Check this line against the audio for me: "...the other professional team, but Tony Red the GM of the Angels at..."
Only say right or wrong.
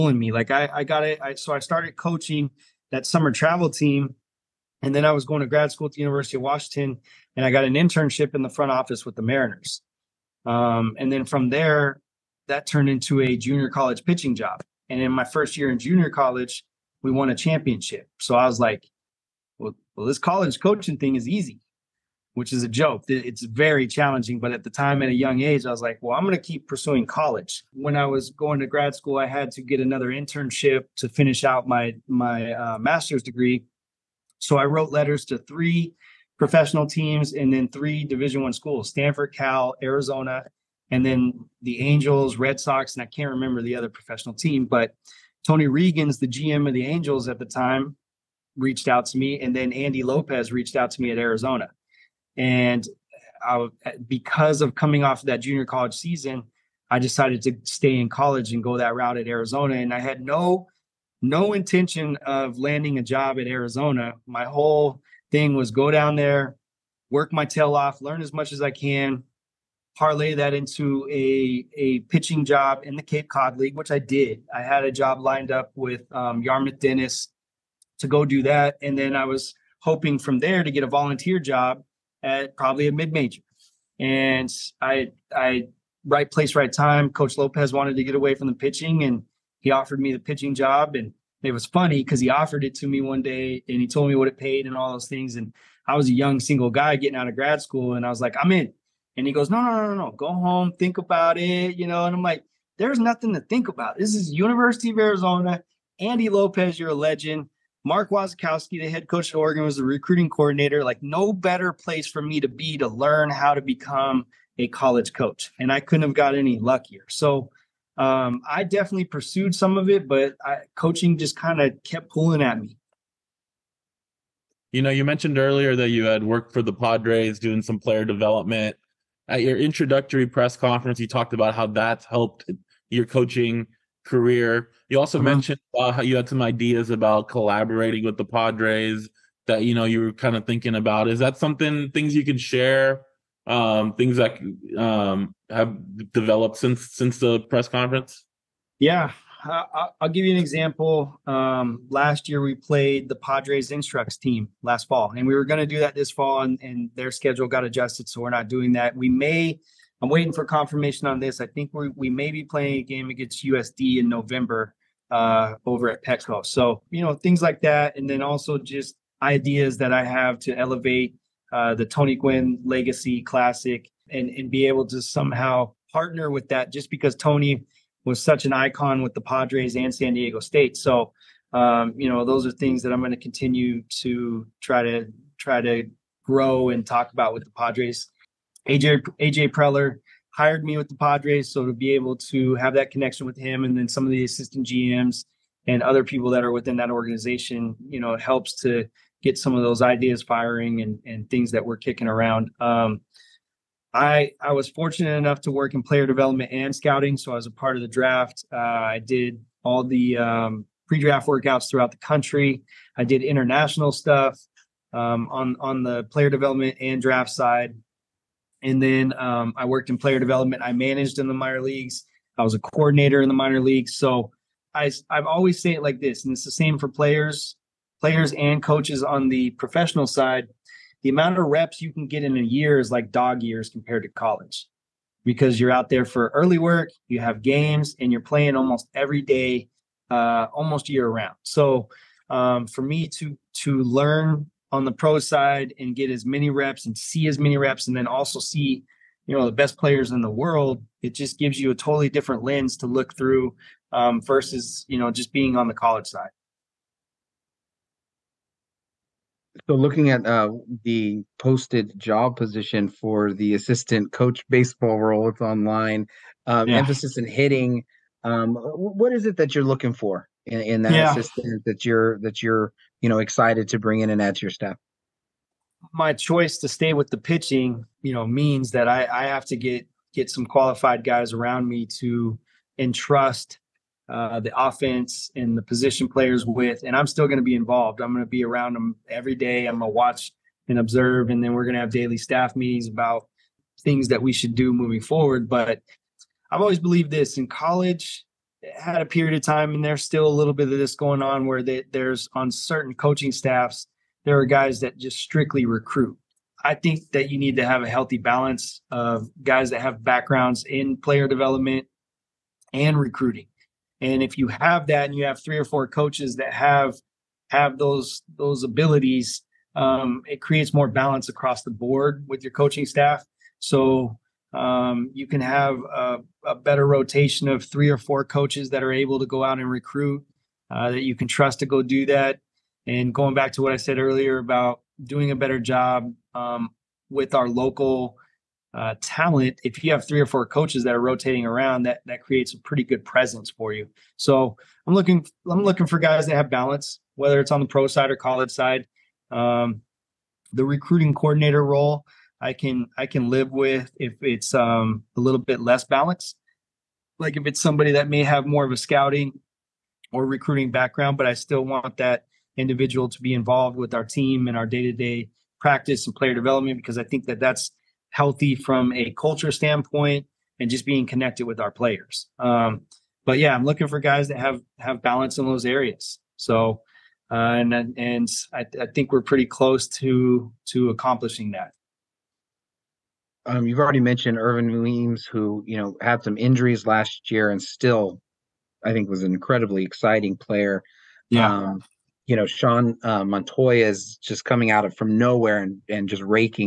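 wrong.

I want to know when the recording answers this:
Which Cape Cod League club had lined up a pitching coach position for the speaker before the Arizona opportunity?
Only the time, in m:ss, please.
1:16.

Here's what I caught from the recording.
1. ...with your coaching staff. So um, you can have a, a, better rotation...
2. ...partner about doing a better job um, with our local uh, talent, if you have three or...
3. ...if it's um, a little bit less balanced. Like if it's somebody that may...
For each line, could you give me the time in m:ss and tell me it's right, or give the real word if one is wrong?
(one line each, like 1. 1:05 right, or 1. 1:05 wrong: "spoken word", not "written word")
1. 5:22 right
2. 5:33 wrong: "earlier", not "partner"
3. 5:53 right.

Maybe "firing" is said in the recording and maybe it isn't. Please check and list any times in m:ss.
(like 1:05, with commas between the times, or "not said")
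3:20.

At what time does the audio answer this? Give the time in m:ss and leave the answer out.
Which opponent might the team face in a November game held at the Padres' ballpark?
2:43.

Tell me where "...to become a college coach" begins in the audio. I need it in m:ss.
1:53.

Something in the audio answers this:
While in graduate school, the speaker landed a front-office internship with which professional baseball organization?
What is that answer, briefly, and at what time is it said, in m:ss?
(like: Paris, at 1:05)
Mariners, at 0:09.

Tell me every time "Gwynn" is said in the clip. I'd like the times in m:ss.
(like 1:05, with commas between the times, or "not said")
2:52.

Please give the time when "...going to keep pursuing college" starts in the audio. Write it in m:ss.
0:26.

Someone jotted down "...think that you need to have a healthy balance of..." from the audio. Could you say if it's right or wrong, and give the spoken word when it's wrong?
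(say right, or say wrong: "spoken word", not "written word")
right.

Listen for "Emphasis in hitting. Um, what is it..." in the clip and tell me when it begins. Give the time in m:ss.
4:26.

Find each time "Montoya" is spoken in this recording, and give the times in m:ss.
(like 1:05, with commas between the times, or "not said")
6:33.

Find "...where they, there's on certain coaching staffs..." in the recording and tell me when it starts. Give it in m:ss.
5:01.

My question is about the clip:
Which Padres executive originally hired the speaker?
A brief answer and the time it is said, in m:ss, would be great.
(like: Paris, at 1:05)
AJ Preller, at 3:09.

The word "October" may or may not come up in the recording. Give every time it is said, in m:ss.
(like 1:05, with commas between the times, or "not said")
not said.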